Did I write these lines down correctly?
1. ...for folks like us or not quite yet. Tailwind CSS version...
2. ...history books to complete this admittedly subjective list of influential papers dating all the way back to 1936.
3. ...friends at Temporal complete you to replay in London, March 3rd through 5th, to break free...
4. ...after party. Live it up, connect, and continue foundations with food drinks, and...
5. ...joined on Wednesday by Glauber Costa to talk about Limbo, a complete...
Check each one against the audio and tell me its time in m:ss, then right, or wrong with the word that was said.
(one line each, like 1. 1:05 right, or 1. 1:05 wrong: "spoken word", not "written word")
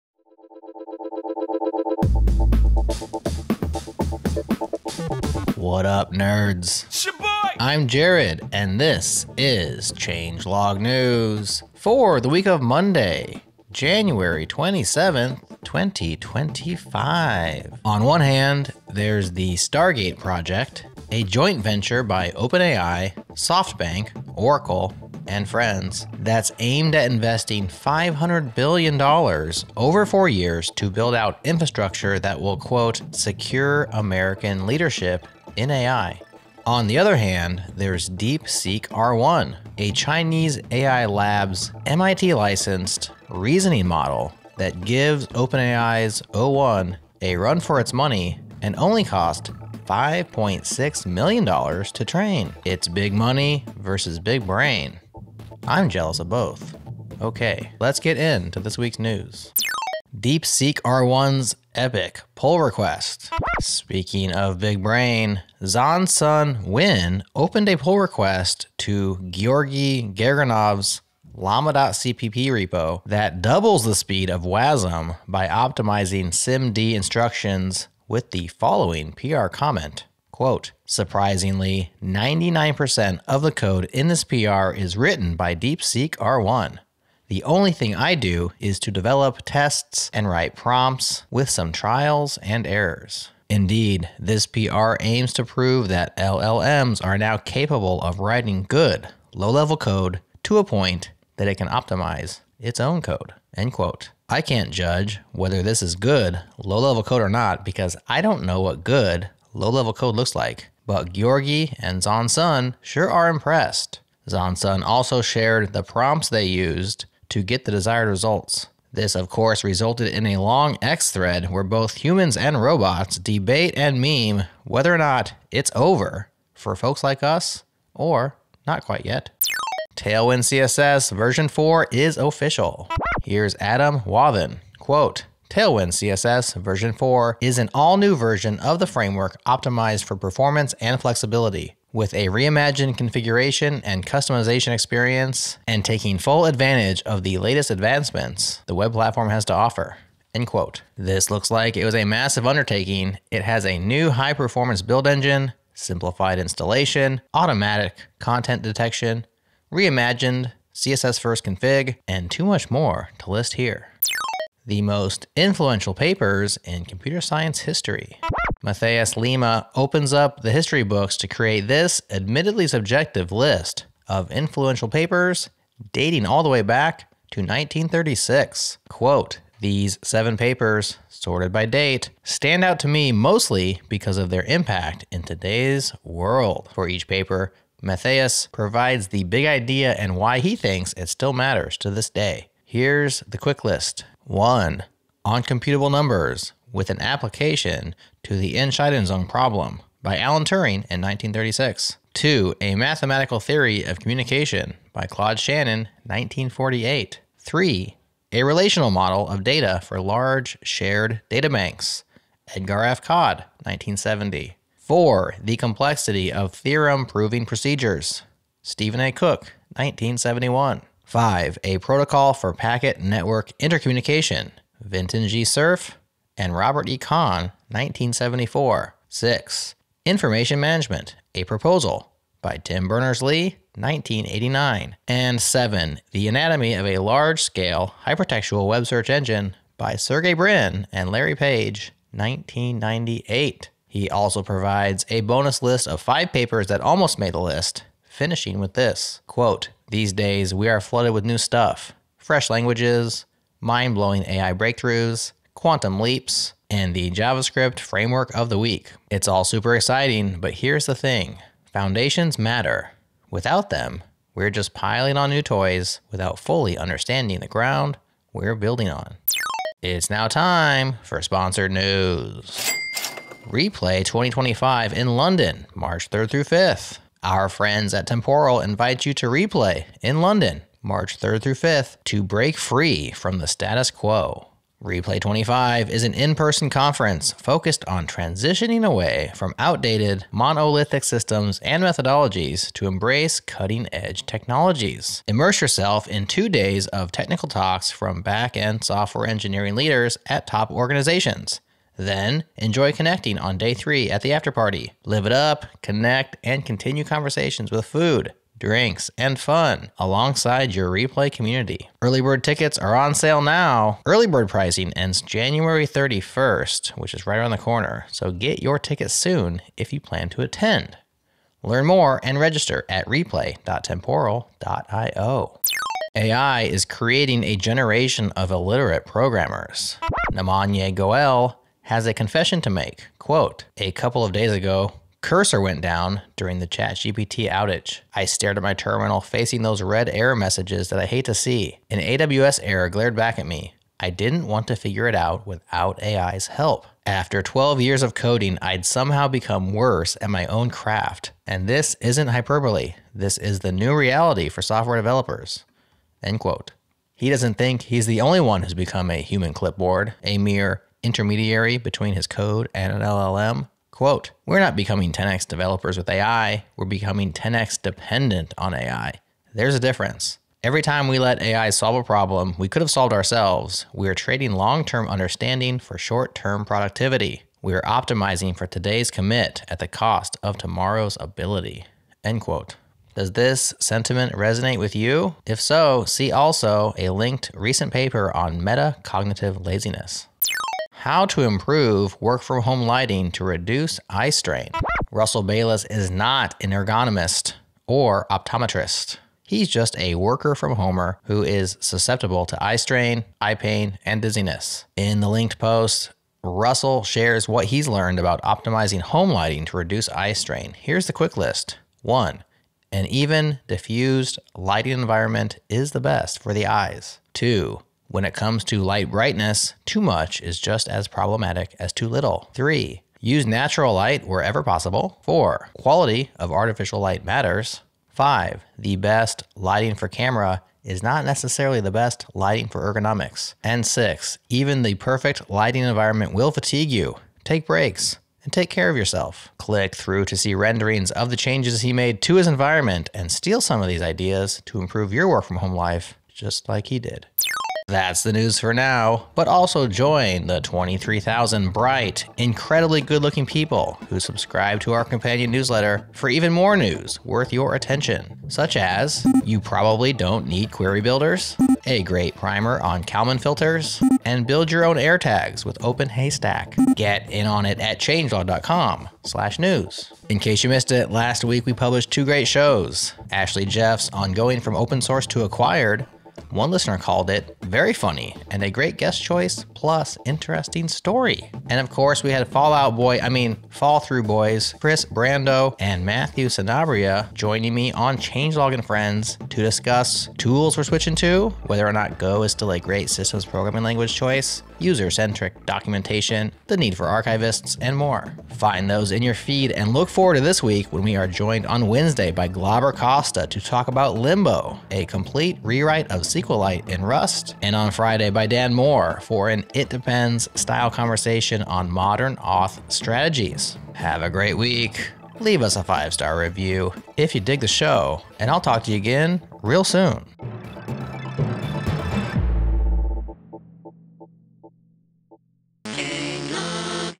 1. 2:06 right
2. 2:50 wrong: "create", not "complete"
3. 4:37 wrong: "invite", not "complete"
4. 5:04 wrong: "conversations", not "foundations"
5. 8:21 right.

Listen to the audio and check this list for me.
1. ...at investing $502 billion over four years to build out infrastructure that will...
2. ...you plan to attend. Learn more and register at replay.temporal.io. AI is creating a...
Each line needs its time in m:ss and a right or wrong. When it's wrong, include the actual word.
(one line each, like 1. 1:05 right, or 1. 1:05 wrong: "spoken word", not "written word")
1. 0:26 wrong: "500", not "502"
2. 5:19 right.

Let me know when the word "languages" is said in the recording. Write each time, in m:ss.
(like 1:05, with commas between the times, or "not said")
4:12, 8:13.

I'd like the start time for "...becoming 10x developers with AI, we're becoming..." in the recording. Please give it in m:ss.
6:04.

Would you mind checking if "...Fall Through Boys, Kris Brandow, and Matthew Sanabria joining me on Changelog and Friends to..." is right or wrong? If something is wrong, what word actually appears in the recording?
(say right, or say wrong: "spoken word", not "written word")
right.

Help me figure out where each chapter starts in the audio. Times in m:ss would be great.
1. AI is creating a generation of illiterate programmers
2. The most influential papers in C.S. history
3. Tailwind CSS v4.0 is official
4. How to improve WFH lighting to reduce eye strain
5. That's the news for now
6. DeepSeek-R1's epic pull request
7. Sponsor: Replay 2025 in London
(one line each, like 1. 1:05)
1. 5:26
2. 2:44
3. 2:09
4. 6:30
5. 7:27
6. 0:59
7. 4:29.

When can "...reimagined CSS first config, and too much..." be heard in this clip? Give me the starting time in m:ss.
2:39.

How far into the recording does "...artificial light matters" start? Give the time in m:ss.
7:06.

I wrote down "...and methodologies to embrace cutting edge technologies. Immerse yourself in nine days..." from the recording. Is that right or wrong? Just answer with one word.
wrong.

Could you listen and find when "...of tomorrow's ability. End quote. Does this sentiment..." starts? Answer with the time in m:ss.
6:20.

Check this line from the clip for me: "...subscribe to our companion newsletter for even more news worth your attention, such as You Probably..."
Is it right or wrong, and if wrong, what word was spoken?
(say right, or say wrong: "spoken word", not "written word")
right.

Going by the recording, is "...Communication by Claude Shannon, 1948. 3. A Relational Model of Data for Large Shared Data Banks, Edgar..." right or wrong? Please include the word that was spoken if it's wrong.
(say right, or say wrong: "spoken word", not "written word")
right.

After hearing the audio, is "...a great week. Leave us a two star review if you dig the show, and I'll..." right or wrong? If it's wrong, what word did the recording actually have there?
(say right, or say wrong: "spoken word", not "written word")
wrong: "five", not "two".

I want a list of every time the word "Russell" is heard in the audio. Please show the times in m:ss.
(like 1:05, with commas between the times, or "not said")
6:35, 6:46.